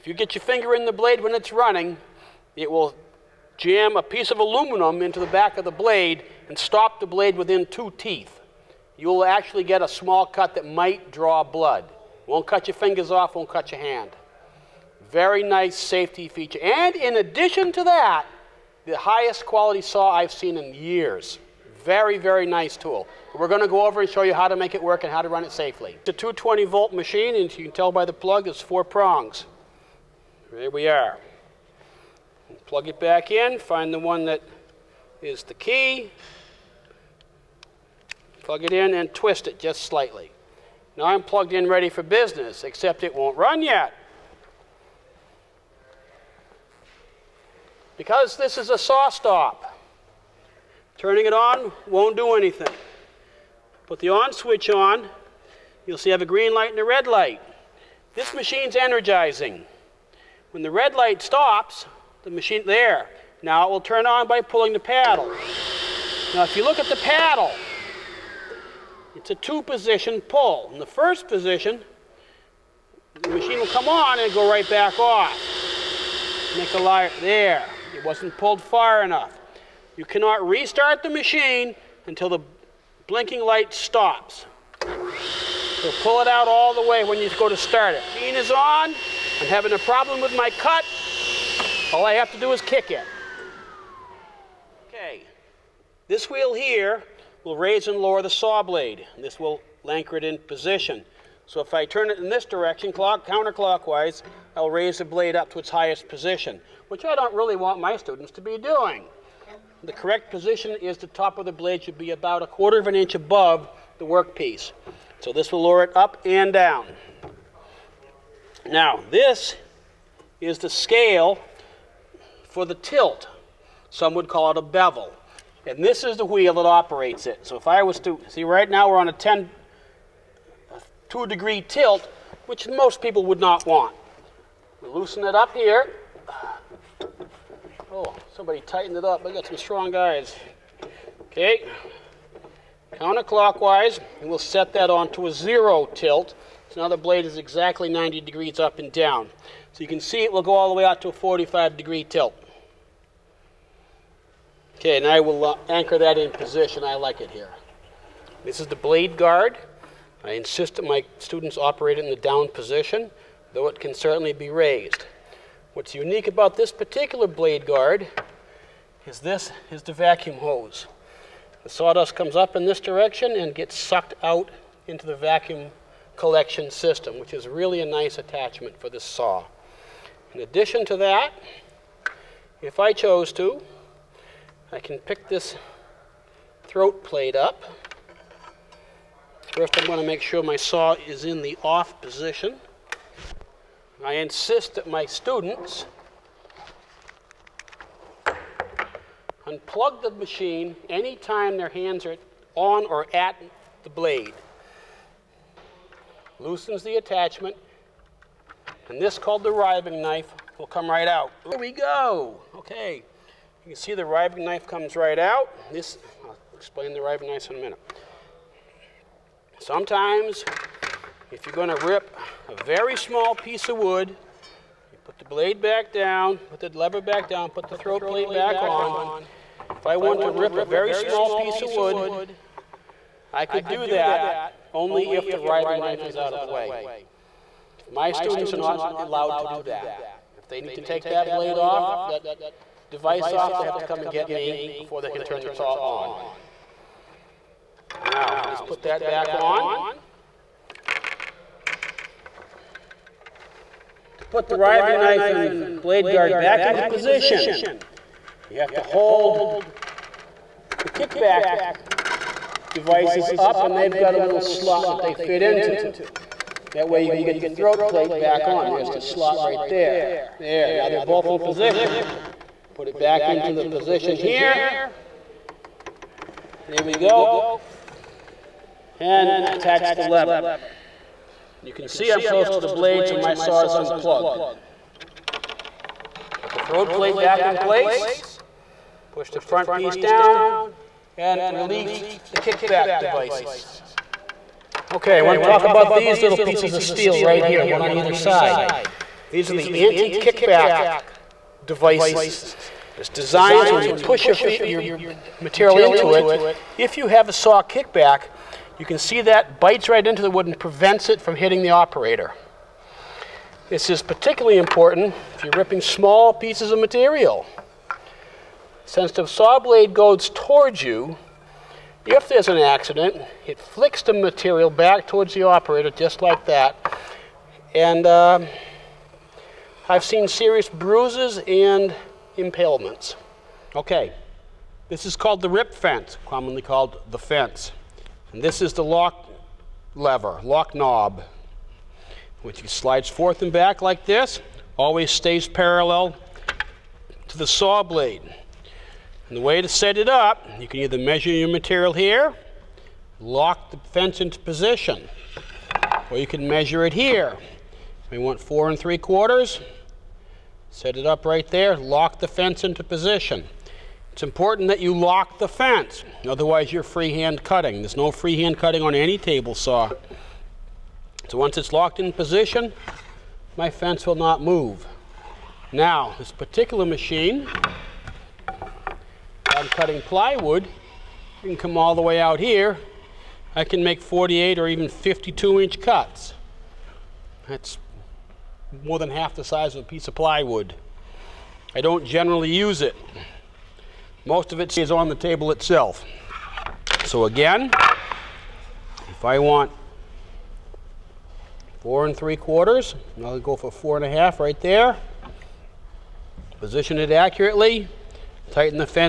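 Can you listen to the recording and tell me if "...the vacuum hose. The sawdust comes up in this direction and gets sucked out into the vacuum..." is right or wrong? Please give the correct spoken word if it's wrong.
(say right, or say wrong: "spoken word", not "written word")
right.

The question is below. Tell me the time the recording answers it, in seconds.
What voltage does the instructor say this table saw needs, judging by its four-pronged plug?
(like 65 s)
26 s.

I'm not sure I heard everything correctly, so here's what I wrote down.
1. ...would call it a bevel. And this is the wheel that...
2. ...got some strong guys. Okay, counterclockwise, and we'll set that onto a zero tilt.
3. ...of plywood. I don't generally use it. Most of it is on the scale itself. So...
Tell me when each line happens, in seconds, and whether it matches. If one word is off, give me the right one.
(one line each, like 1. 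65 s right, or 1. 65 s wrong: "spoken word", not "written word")
1. 124 s right
2. 139 s right
3. 390 s wrong: "table", not "scale".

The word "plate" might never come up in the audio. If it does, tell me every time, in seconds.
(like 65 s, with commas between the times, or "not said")
187 s, 228 s, 267 s, 286 s.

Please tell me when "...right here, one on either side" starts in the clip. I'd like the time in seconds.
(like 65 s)
297 s.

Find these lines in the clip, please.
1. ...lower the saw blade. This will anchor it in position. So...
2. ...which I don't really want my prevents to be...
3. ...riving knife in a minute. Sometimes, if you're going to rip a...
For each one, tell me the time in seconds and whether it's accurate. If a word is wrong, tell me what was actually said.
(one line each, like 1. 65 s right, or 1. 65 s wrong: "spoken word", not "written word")
1. 97 s right
2. 106 s wrong: "students", not "prevents"
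3. 217 s right.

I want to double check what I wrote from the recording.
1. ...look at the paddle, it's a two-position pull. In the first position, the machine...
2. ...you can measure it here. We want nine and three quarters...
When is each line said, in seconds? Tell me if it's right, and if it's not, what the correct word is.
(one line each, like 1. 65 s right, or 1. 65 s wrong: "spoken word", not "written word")
1. 66 s right
2. 356 s wrong: "four", not "nine".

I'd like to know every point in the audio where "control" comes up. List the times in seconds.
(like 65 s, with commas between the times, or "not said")
not said.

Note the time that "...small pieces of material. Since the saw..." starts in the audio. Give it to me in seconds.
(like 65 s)
315 s.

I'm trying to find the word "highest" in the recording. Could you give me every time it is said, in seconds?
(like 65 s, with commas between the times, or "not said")
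18 s, 105 s.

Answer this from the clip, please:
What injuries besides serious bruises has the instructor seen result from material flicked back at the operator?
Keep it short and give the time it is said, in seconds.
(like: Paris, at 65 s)
impalements, at 332 s.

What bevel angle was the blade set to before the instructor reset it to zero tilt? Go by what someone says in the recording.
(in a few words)
2 degrees.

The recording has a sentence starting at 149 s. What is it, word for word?
So you can see it will go all the way out to a 45 degree tilt.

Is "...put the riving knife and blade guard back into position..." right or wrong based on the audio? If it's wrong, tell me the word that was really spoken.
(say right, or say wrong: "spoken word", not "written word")
right.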